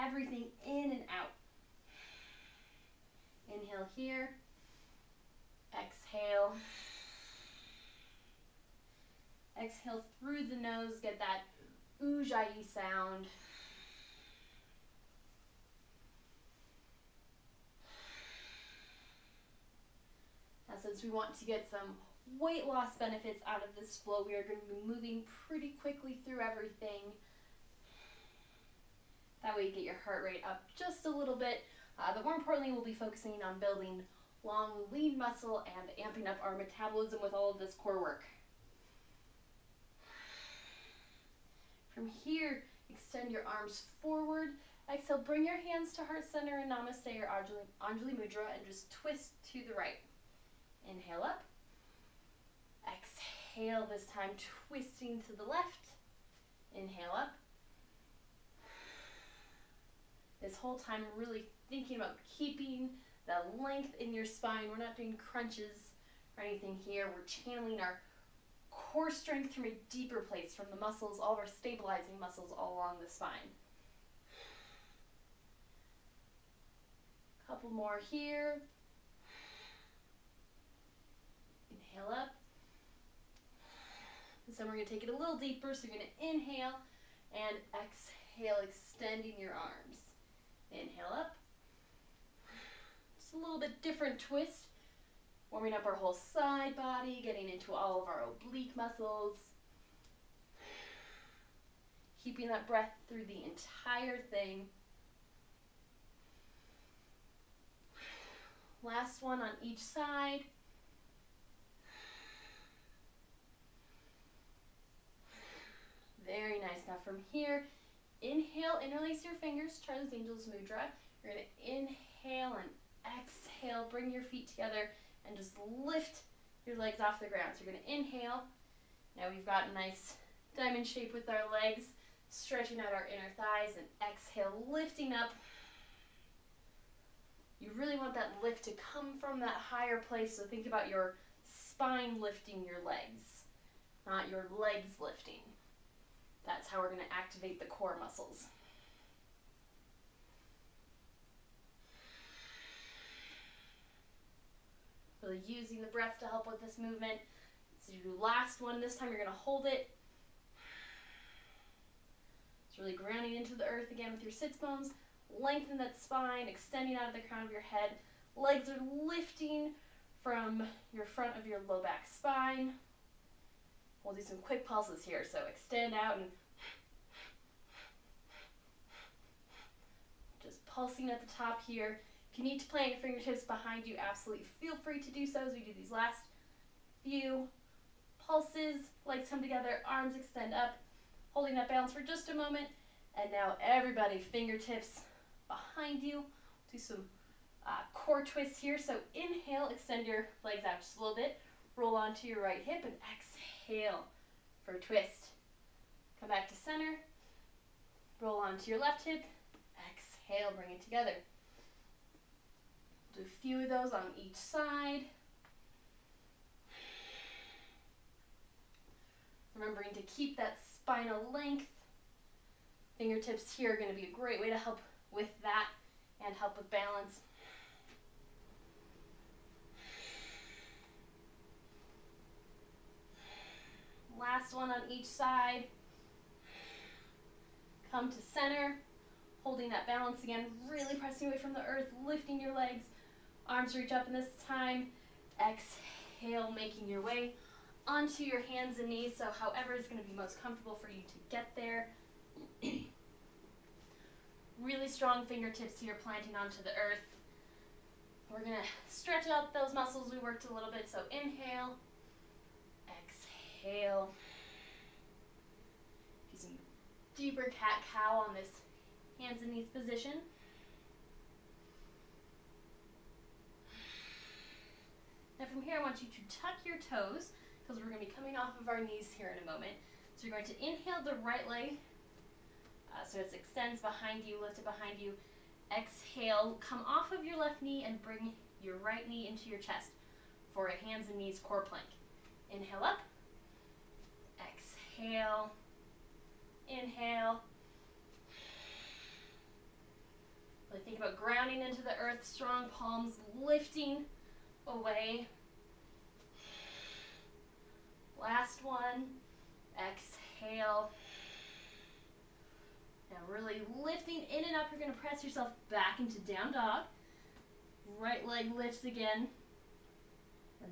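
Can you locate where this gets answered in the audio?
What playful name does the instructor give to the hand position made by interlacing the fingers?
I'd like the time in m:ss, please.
1:59.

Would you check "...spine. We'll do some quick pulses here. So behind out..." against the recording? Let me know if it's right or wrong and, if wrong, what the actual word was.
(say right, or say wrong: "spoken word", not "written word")
wrong: "extend", not "behind".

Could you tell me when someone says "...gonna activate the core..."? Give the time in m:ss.
2:26.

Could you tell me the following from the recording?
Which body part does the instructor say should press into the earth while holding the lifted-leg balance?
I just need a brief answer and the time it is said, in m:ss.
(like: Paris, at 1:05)
sits bones, at 2:44.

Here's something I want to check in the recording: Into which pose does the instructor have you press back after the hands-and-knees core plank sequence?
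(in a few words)
down dog.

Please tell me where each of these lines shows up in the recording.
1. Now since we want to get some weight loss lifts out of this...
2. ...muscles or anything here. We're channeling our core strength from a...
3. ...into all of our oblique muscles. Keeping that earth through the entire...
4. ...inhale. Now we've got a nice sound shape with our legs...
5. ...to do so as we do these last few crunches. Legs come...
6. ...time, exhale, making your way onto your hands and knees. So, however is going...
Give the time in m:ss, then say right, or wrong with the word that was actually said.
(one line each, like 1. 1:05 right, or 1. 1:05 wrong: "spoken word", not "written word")
1. 0:20 wrong: "benefits", not "lifts"
2. 1:05 wrong: "crunches", not "muscles"
3. 1:37 wrong: "breath", not "earth"
4. 2:07 wrong: "diamond", not "sound"
5. 3:05 wrong: "pulses", not "crunches"
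6. 4:04 right.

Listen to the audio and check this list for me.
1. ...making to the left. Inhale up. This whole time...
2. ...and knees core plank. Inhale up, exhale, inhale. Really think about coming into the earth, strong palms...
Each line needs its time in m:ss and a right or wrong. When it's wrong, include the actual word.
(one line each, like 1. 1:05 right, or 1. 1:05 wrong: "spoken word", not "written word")
1. 0:54 wrong: "twisting", not "making"
2. 4:51 wrong: "grounding", not "coming".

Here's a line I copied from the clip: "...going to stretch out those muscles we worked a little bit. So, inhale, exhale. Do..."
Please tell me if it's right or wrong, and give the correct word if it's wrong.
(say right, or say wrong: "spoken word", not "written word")
right.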